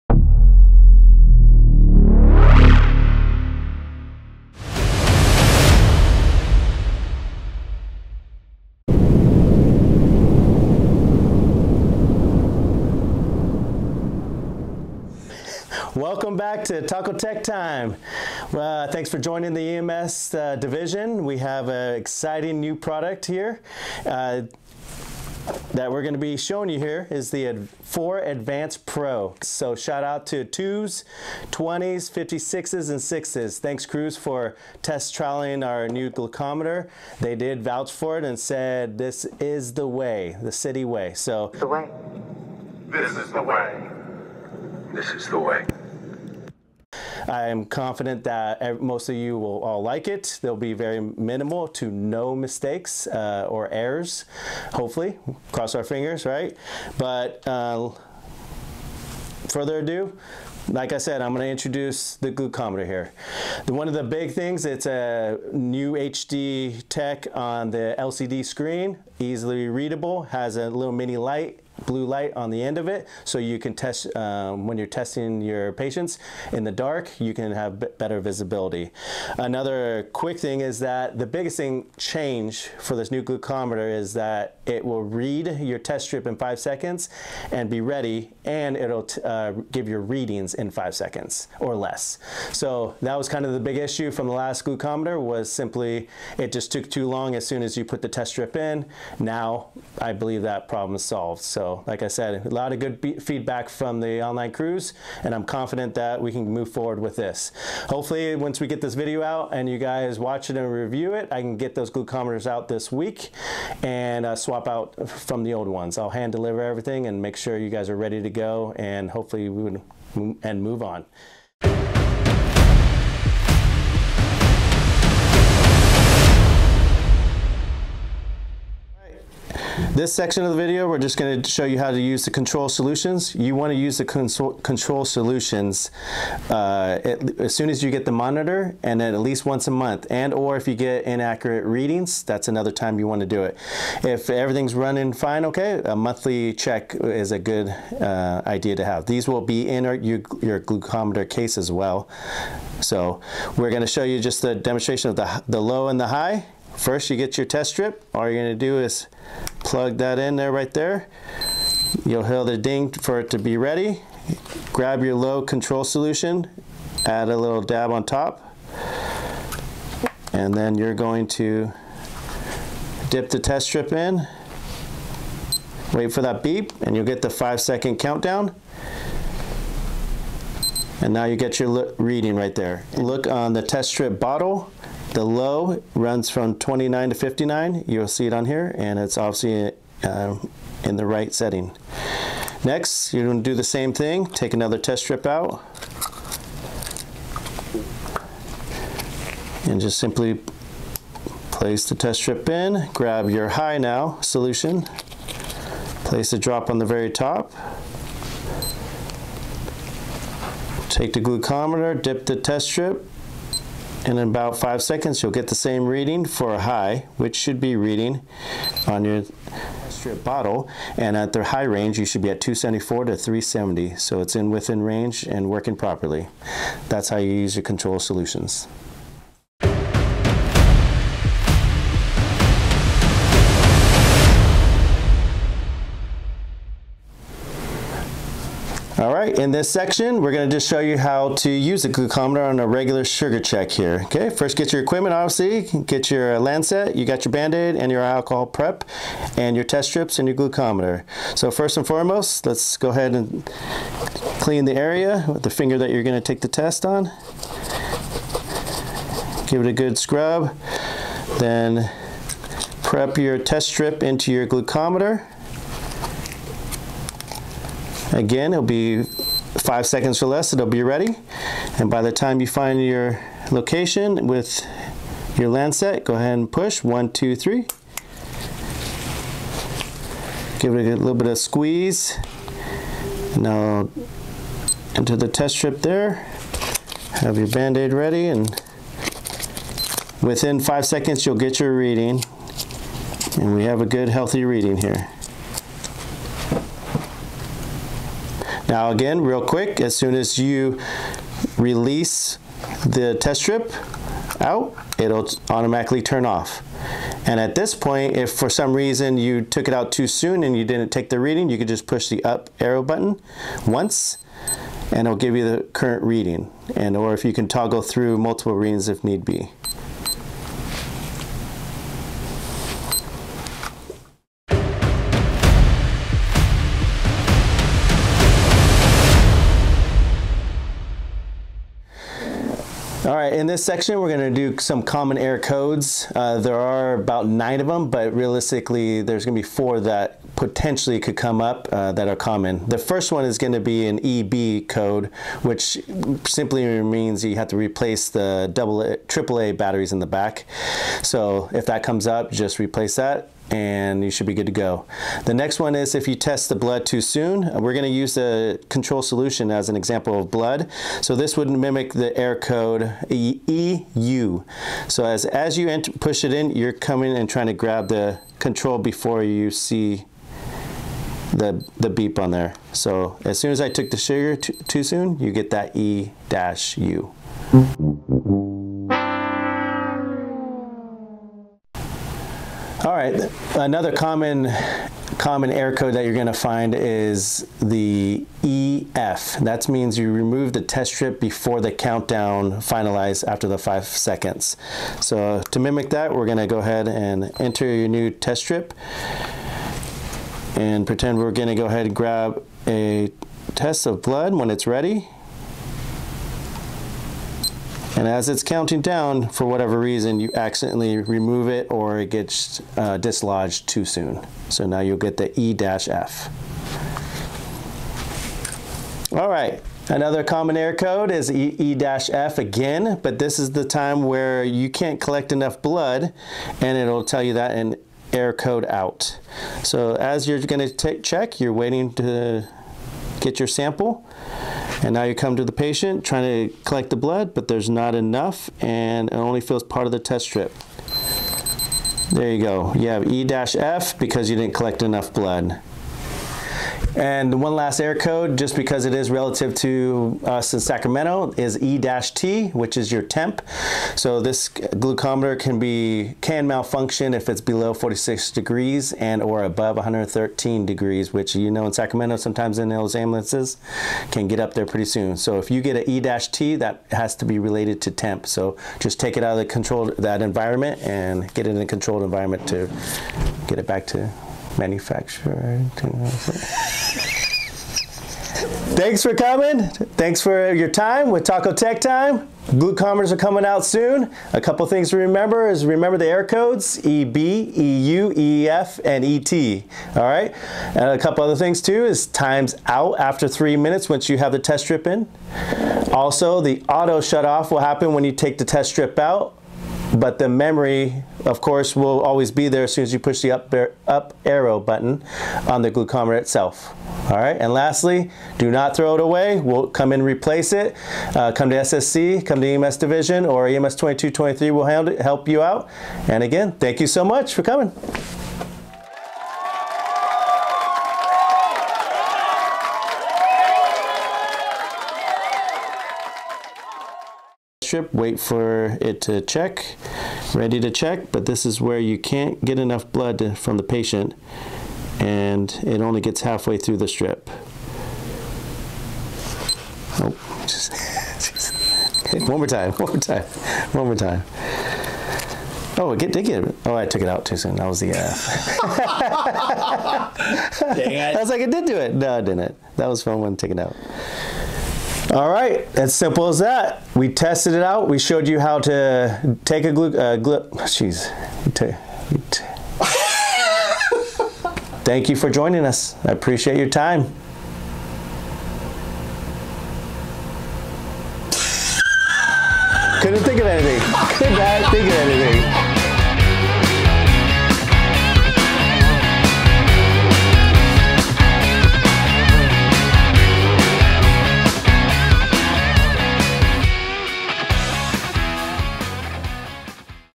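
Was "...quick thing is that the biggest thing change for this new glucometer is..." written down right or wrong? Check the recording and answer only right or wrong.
right.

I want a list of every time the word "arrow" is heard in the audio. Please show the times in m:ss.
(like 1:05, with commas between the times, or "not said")
5:12, 8:24.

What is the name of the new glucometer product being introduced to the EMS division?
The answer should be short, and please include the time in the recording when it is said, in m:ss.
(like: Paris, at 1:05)
Ad 4 Advanced Pro, at 0:27.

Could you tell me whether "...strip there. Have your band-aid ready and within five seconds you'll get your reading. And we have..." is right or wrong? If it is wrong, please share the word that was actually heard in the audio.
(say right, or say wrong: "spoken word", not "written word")
right.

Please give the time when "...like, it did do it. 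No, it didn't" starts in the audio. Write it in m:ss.
9:11.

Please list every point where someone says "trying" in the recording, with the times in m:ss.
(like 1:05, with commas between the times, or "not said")
6:07, 7:16.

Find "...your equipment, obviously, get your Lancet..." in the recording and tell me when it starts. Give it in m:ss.
4:04.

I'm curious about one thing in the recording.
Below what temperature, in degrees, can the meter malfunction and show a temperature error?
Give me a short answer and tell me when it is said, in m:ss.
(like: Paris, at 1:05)
46 degrees, at 7:37.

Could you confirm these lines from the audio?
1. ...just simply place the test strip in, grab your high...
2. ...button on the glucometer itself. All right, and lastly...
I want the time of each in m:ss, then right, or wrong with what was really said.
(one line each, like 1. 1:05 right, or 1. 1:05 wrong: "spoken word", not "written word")
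1. 3:19 right
2. 8:24 right.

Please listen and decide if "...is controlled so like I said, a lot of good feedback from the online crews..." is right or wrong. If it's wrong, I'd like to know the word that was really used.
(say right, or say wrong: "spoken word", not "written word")
wrong: "solved", not "controlled".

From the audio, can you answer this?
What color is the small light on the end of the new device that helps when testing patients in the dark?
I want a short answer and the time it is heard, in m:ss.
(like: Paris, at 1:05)
light blue, at 1:11.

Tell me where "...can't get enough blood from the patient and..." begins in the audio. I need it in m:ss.
8:51.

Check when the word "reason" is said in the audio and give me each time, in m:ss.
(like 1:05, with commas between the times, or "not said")
5:08, 6:49.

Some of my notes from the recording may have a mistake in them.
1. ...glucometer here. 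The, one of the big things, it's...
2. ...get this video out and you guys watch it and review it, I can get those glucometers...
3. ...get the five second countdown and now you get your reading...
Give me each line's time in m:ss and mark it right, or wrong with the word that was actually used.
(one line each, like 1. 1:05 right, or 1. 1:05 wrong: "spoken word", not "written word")
1. 1:02 right
2. 1:48 right
3. 2:57 right.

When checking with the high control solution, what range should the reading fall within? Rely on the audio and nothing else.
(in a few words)
274 to 370.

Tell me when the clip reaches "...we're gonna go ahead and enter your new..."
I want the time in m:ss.
6:36.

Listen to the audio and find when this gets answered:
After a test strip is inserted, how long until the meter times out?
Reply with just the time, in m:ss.
8:13.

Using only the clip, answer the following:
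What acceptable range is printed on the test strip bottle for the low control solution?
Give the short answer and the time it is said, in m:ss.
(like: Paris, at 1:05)
29 to 59, at 3:06.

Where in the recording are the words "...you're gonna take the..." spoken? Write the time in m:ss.
4:15.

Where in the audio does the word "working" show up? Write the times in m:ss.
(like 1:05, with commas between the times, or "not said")
3:45.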